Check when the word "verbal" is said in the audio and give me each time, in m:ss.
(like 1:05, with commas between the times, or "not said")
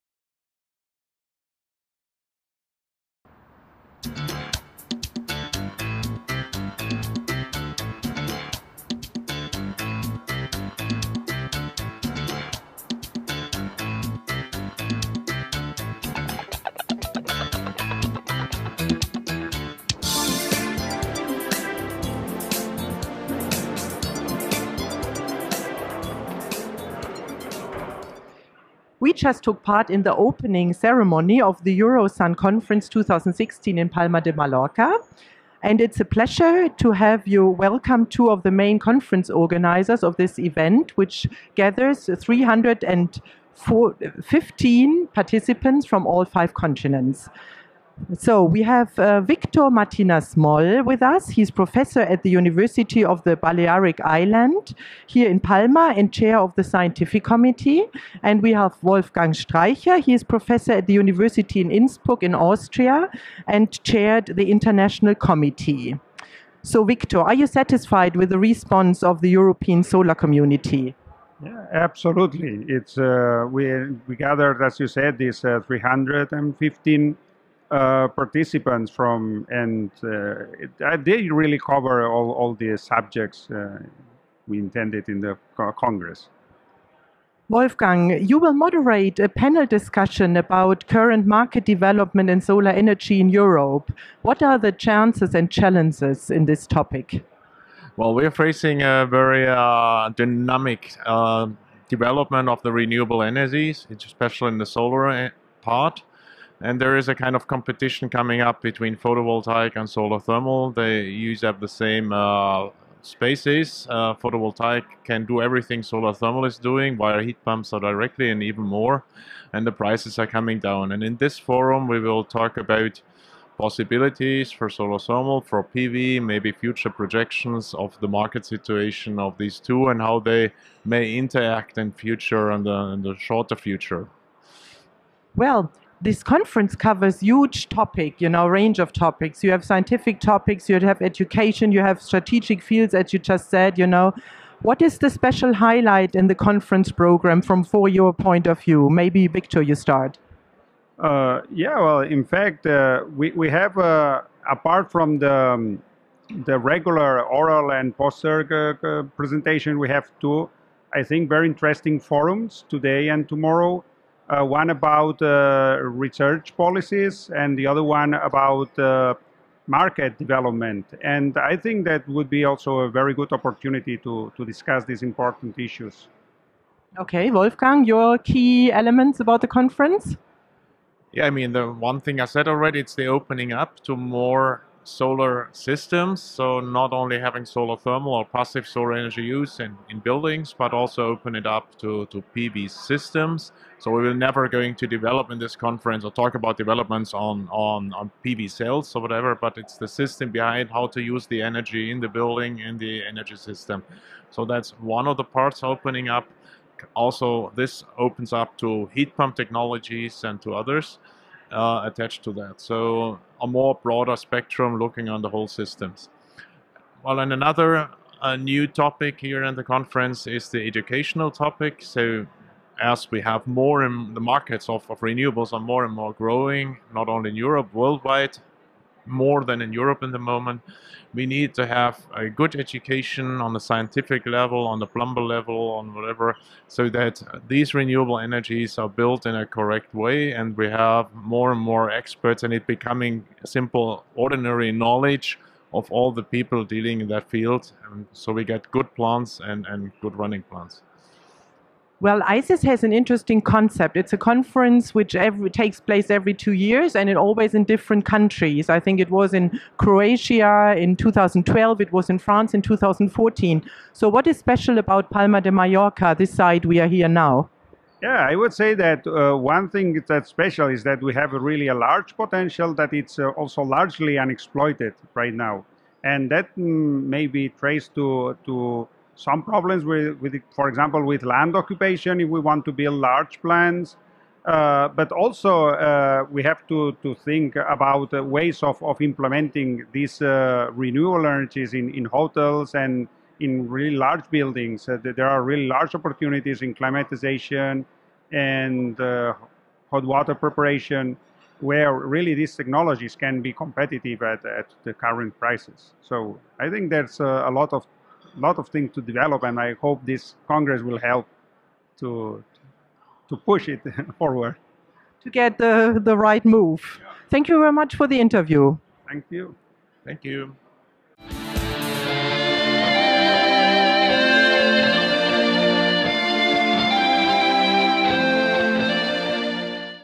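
not said.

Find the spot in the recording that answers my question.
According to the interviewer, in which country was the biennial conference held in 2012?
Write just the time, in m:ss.
4:19.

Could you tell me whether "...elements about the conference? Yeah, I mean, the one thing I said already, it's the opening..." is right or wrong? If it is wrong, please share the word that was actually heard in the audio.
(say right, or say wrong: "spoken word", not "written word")
right.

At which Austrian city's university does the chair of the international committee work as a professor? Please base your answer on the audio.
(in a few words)
Innsbruck.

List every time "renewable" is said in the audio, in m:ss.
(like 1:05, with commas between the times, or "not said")
1:42, 3:45, 3:57, 4:50.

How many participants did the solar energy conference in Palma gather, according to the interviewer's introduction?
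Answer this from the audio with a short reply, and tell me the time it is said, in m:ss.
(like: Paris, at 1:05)
315, at 0:42.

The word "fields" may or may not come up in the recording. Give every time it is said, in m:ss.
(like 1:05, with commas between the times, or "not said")
2:22, 4:07.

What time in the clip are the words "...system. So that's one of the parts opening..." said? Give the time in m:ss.
3:23.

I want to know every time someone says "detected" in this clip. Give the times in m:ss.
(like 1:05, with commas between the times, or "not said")
not said.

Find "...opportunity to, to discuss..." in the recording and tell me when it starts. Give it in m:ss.
2:53.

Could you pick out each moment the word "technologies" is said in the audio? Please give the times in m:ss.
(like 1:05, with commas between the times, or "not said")
3:29, 5:02.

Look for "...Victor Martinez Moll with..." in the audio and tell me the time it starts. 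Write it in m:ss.
0:49.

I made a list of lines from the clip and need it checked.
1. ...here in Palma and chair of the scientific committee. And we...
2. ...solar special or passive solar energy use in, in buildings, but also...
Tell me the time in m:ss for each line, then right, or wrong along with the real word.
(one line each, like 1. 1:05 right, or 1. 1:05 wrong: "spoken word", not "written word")
1. 0:55 right
2. 3:07 wrong: "thermal", not "special".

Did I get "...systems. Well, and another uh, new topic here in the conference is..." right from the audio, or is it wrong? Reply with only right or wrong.
right.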